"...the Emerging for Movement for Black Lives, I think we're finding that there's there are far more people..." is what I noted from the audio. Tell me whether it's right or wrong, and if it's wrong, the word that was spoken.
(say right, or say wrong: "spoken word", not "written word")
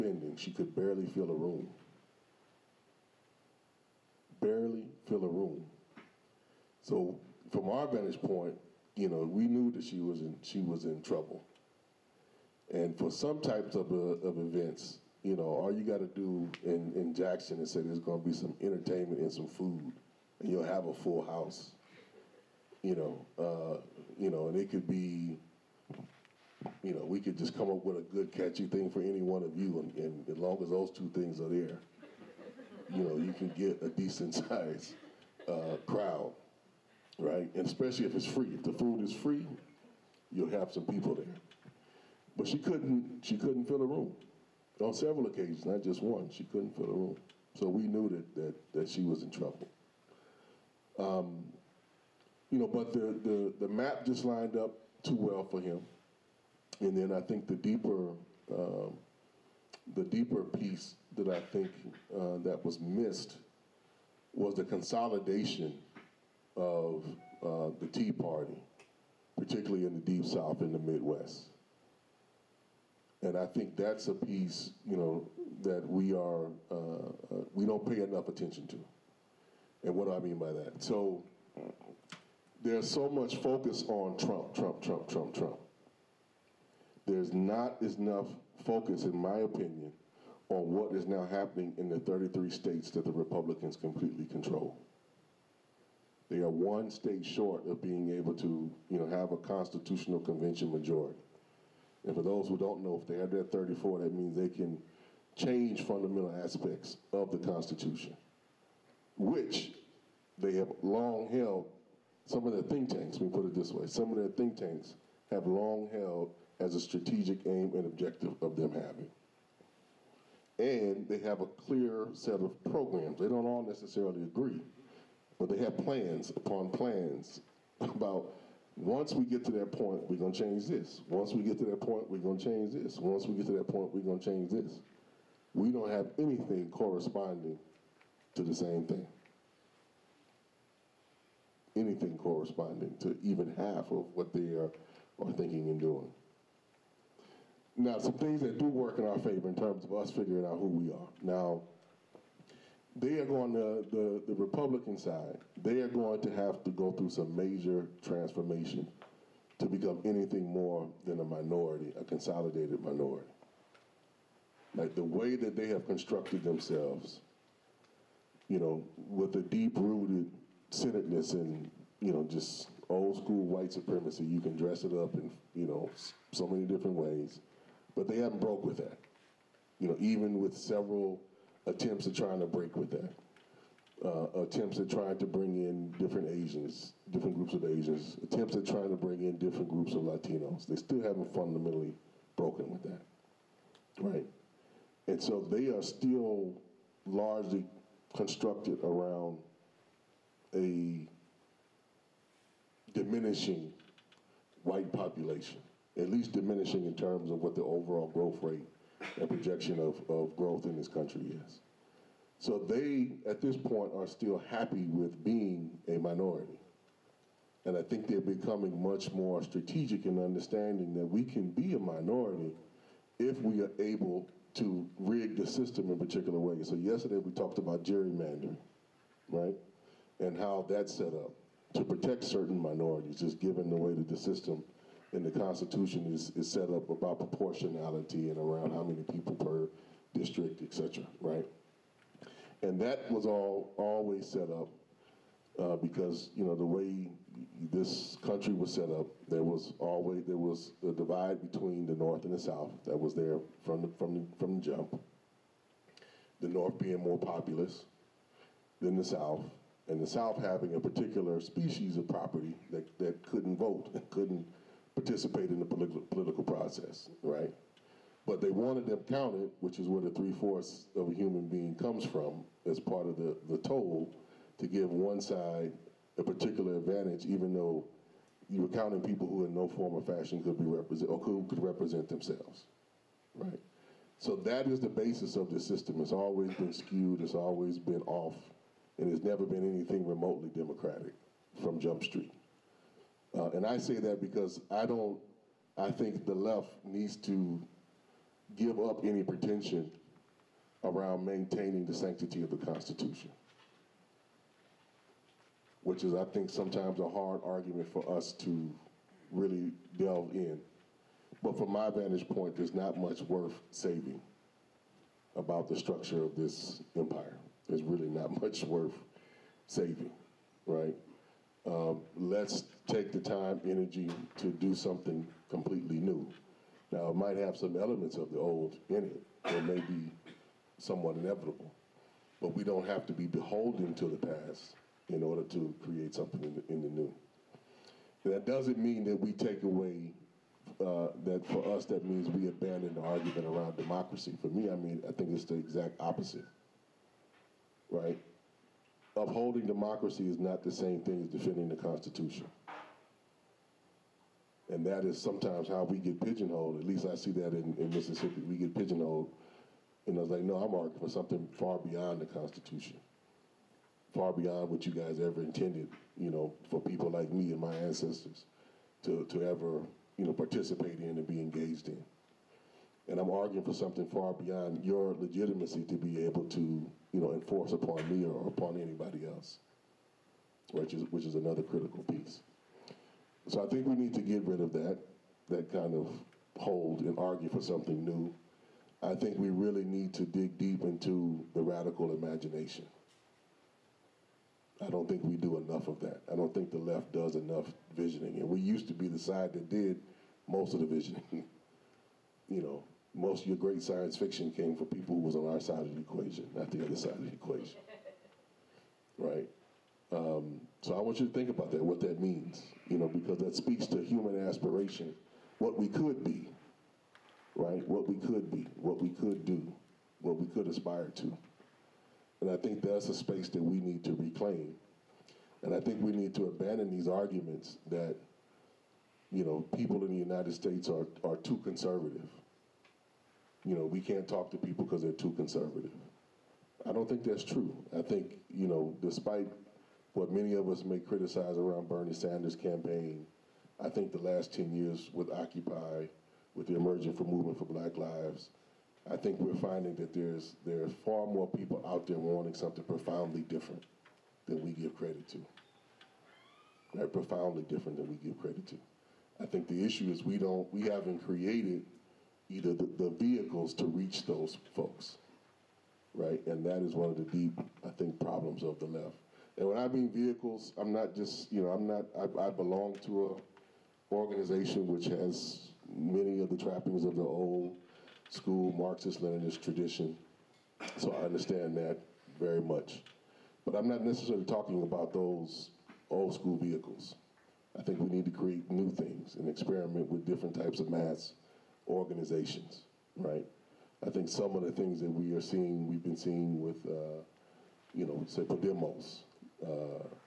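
right.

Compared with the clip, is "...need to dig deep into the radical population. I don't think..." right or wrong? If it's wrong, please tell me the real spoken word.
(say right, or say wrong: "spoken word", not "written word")
wrong: "imagination", not "population".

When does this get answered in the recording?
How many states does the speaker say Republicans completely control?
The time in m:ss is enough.
1:31.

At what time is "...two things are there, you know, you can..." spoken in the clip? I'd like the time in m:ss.
0:30.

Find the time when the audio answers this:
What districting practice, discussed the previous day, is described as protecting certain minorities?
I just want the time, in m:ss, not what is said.
3:47.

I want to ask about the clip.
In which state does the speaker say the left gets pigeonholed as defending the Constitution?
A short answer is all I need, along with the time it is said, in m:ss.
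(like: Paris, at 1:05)
Mississippi, at 5:57.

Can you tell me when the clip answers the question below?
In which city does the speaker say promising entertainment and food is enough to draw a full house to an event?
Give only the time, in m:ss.
0:17.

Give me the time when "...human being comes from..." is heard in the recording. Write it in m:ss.
4:31.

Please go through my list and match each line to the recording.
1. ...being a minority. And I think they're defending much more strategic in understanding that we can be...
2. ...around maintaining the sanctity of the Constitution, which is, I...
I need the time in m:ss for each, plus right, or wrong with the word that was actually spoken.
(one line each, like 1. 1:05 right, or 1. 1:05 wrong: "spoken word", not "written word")
1. 3:35 wrong: "becoming", not "defending"
2. 5:00 right.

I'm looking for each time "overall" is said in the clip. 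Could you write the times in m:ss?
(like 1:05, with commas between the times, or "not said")
3:27.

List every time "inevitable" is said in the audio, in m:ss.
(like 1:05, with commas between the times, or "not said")
5:31.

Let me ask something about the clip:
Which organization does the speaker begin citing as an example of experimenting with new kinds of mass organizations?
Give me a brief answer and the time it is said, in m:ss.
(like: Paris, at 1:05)
Podemos, at 8:18.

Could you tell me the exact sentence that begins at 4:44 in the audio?
So that is the basis of the system.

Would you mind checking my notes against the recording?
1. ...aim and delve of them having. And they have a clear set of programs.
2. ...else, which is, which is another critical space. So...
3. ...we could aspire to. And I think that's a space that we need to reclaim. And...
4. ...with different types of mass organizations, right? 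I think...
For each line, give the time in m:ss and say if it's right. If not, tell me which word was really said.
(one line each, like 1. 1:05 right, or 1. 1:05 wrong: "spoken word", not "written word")
1. 1:57 wrong: "objective", not "delve"
2. 6:19 wrong: "piece", not "space"
3. 7:00 right
4. 8:10 right.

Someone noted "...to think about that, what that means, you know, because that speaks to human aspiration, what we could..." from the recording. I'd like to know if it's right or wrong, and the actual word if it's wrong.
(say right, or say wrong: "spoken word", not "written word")
right.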